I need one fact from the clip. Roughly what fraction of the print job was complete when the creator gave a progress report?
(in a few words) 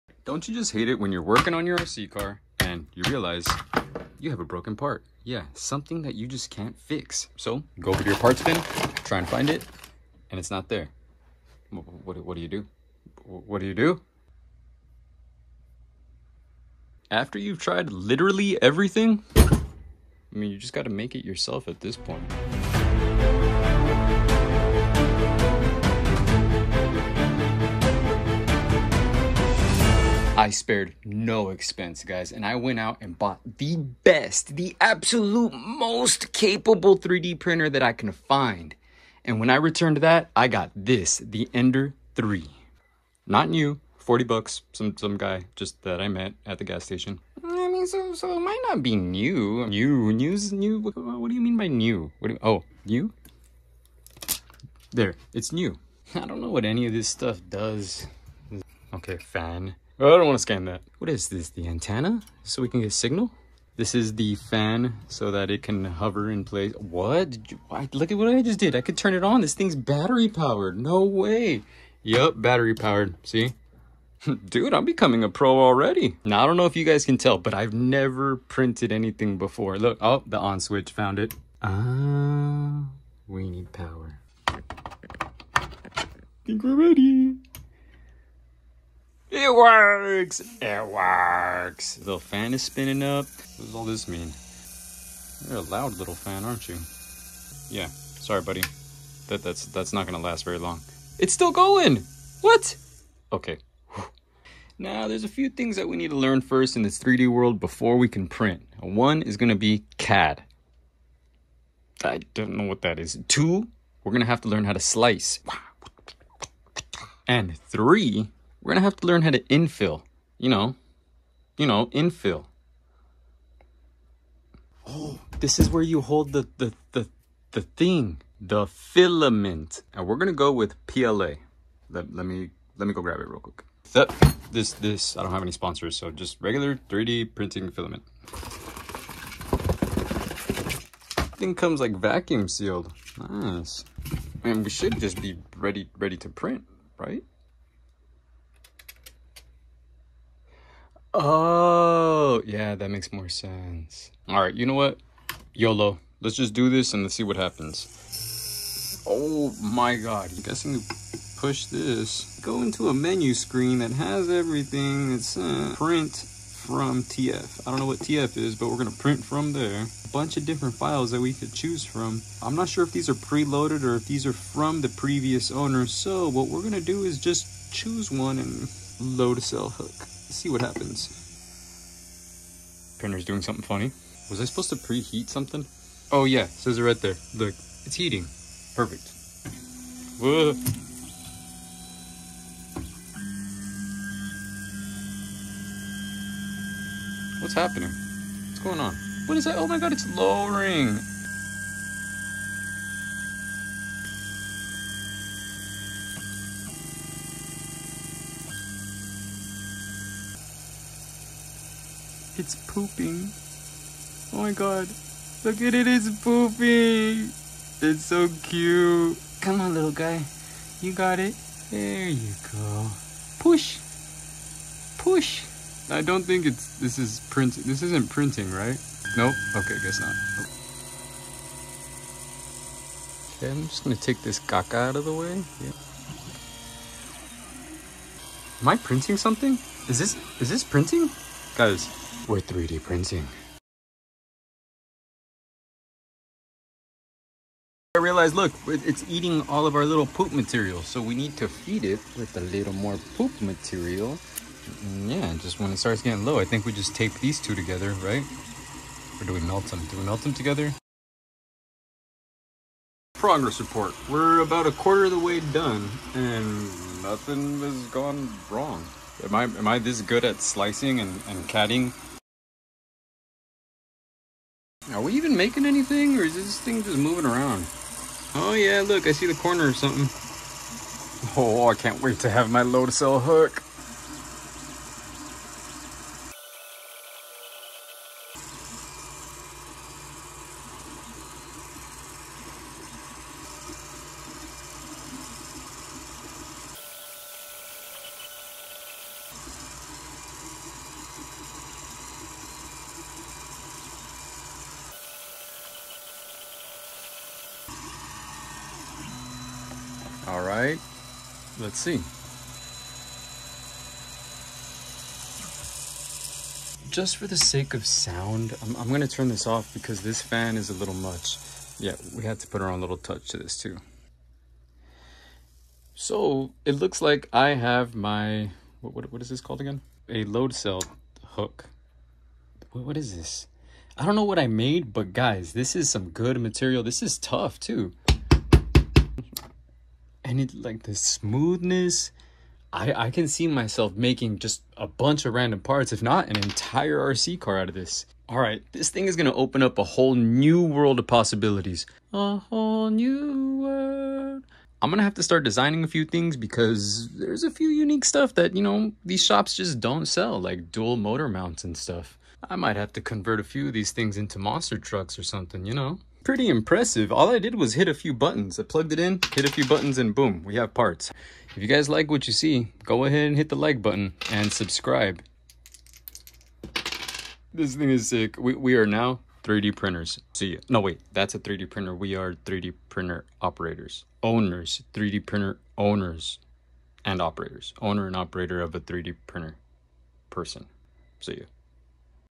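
a quarter.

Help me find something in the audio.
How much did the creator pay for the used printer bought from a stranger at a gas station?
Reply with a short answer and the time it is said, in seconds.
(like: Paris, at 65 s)
$40, at 43 s.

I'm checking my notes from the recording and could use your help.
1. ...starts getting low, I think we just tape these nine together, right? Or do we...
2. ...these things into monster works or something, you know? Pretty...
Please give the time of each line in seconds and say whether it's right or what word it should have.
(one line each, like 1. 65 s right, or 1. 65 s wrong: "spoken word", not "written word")
1. 255 s wrong: "two", not "nine"
2. 363 s wrong: "trucks", not "works".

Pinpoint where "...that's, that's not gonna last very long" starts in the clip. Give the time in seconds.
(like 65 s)
99 s.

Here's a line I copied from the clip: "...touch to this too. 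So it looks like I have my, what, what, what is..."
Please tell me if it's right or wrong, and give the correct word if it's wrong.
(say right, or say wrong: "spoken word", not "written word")
right.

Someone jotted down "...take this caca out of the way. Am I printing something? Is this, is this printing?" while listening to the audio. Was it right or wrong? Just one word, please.
right.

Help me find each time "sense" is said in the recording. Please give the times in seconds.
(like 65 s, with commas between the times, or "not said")
153 s.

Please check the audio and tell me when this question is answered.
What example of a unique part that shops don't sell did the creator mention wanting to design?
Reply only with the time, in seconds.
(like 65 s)
360 s.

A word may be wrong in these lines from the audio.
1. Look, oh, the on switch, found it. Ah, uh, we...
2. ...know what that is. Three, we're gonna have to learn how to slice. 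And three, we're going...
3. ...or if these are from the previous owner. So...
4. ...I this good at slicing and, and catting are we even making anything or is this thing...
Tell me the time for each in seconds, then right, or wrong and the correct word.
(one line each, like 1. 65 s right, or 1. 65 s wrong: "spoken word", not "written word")
1. 79 s right
2. 112 s wrong: "Two", not "Three"
3. 173 s right
4. 269 s right.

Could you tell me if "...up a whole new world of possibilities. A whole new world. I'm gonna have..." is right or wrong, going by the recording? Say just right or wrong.
right.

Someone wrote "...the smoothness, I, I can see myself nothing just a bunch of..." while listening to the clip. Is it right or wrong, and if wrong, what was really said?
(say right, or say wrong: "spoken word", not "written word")
wrong: "making", not "nothing".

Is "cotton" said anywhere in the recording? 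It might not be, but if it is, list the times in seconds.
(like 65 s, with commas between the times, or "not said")
not said.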